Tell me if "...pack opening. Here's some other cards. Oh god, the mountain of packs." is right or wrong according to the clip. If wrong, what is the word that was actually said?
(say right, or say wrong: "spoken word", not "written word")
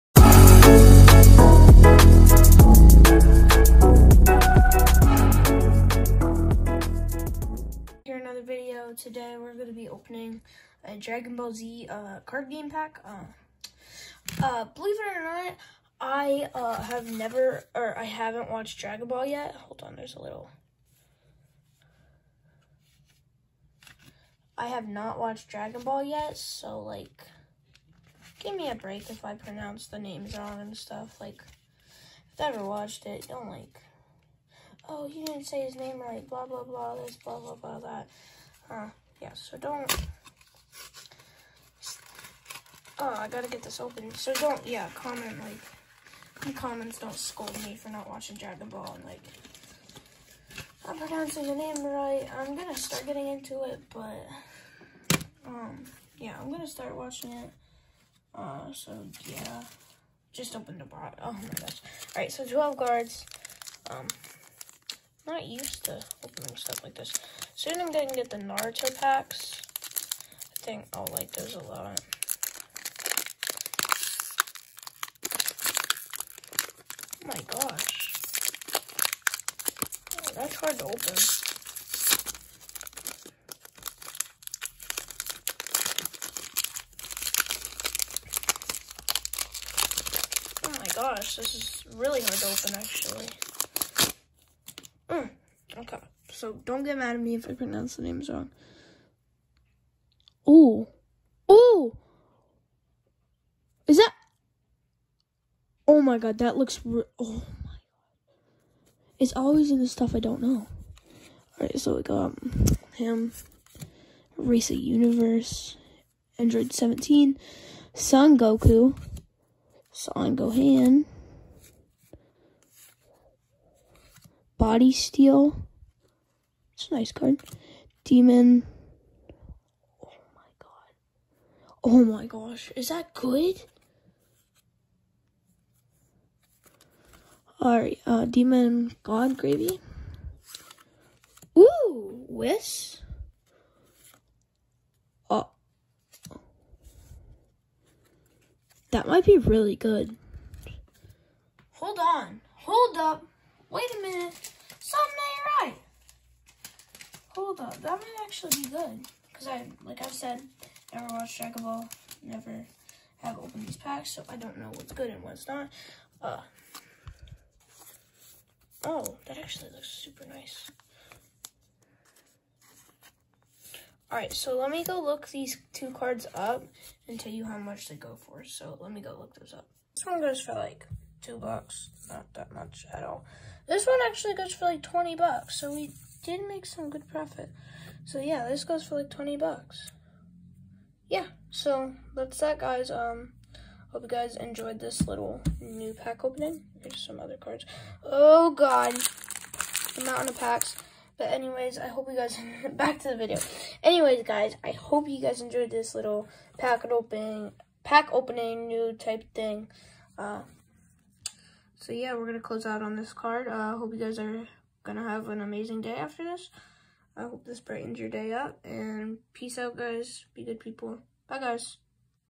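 right.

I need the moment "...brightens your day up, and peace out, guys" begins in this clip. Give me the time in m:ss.
3:37.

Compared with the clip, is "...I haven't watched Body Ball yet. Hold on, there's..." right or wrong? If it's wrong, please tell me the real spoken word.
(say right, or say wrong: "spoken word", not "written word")
wrong: "Dragon", not "Body".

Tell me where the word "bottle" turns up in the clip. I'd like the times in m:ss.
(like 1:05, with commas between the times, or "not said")
1:00.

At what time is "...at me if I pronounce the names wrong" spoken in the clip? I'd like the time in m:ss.
1:37.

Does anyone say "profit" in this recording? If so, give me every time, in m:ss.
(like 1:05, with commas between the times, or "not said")
3:07.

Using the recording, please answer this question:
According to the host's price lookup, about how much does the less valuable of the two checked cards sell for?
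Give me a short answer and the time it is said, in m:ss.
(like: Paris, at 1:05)
two bucks, at 3:01.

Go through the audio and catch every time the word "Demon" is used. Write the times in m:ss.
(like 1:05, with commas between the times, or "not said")
2:08, 2:18.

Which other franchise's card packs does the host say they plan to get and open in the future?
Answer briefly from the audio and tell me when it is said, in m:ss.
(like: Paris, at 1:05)
Naruto, at 1:08.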